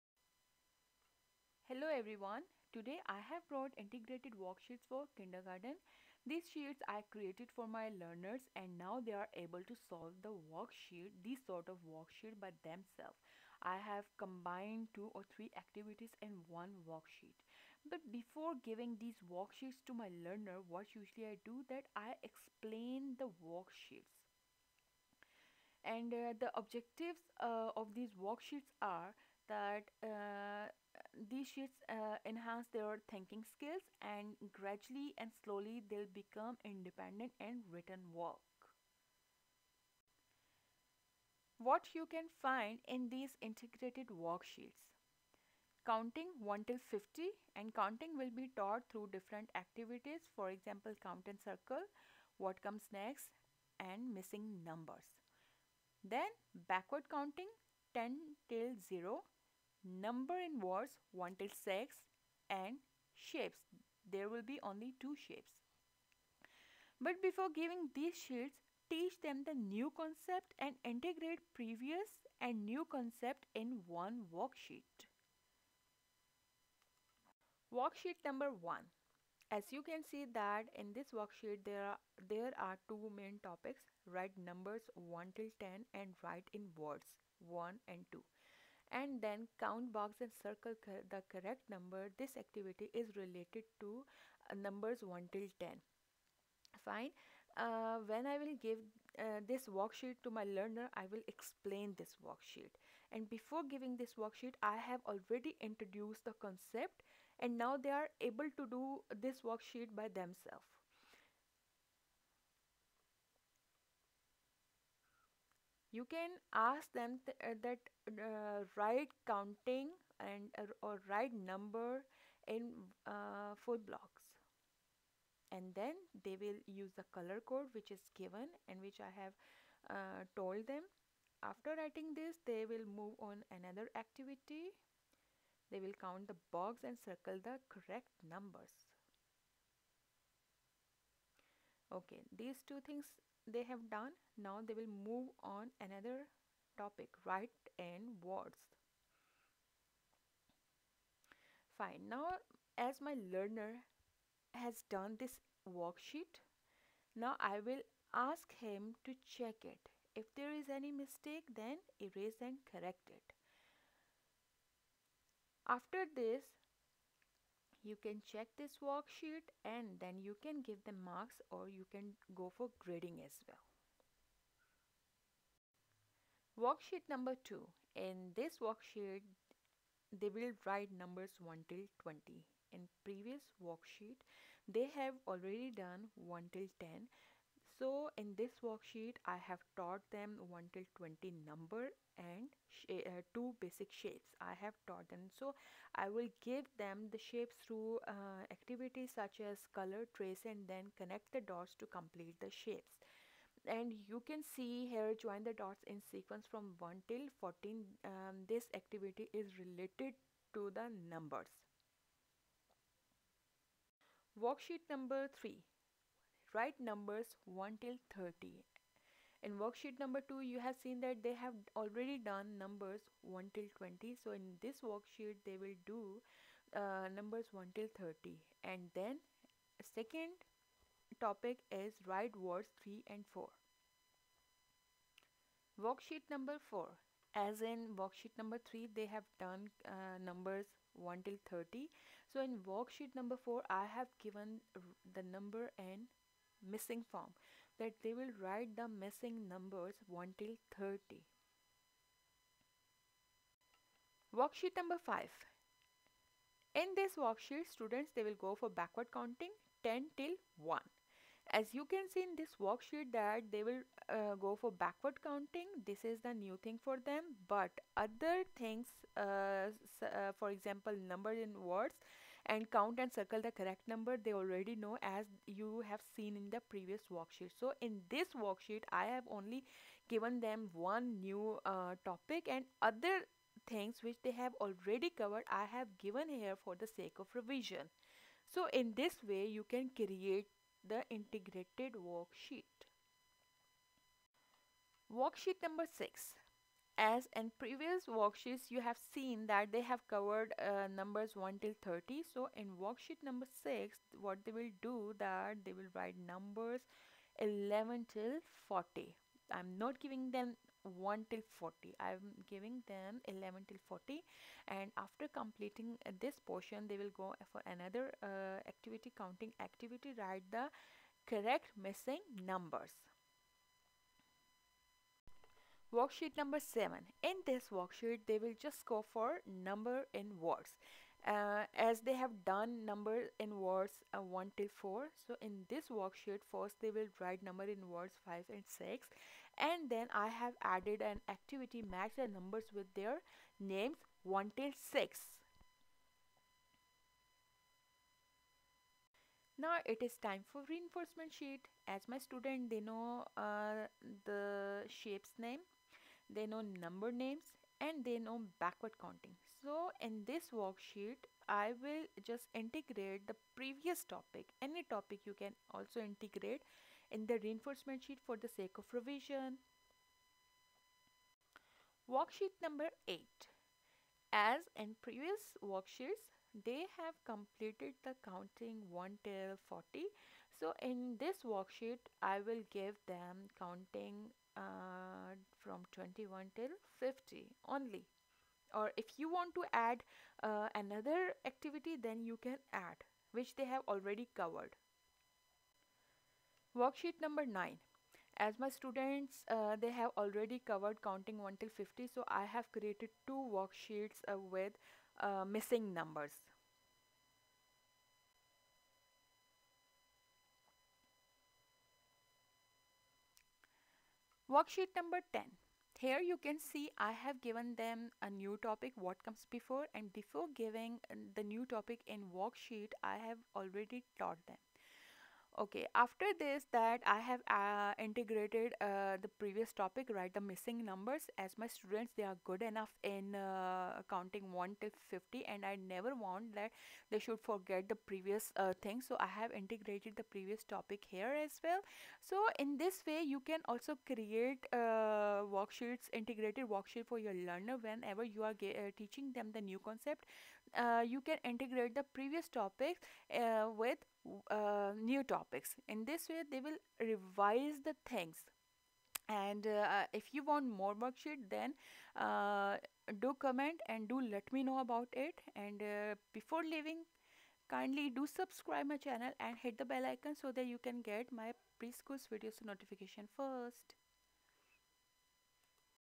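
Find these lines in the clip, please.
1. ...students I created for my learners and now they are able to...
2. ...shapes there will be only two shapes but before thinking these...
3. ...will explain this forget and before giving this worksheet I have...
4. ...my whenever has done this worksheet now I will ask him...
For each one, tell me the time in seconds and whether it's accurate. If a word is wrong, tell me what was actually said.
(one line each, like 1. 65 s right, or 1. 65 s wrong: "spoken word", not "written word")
1. 6 s wrong: "sheets", not "students"
2. 63 s wrong: "giving", not "thinking"
3. 101 s wrong: "worksheet", not "forget"
4. 153 s wrong: "learner", not "whenever".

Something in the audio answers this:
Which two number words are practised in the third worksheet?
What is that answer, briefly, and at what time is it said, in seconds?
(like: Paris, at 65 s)
3 and 4, at 232 s.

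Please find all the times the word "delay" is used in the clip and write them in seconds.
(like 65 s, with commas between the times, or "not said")
not said.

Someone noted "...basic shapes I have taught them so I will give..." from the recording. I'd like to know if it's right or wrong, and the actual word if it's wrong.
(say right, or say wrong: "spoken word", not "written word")
right.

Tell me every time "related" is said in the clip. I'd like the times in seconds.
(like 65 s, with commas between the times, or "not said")
93 s, 209 s.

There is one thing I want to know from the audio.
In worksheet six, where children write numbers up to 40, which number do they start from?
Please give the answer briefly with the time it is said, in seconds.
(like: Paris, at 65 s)
11, at 305 s.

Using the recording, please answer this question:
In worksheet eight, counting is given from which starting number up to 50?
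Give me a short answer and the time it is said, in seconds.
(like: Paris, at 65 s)
21, at 385 s.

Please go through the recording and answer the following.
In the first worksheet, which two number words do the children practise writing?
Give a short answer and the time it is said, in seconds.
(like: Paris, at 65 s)
1 and 2, at 86 s.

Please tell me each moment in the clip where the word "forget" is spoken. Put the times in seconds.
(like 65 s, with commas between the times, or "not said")
437 s.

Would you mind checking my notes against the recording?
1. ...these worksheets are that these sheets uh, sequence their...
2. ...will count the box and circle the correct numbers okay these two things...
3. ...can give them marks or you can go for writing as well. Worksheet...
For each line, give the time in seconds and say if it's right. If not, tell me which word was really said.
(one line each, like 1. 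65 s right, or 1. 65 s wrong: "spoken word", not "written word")
1. 27 s wrong: "enhance", not "sequence"
2. 135 s right
3. 170 s wrong: "grading", not "writing".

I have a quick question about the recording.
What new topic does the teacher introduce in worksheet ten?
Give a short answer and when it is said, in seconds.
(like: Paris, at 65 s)
what comes before, at 418 s.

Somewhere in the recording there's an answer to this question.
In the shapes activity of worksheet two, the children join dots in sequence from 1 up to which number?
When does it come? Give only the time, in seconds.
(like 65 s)
206 s.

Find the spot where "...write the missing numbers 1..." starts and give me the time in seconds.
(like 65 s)
248 s.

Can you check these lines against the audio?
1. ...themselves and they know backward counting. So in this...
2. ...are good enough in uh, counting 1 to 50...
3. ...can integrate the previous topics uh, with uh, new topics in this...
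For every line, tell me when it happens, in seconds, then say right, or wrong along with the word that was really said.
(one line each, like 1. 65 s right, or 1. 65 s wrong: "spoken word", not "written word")
1. 357 s wrong: "names", not "themselves"
2. 432 s right
3. 451 s right.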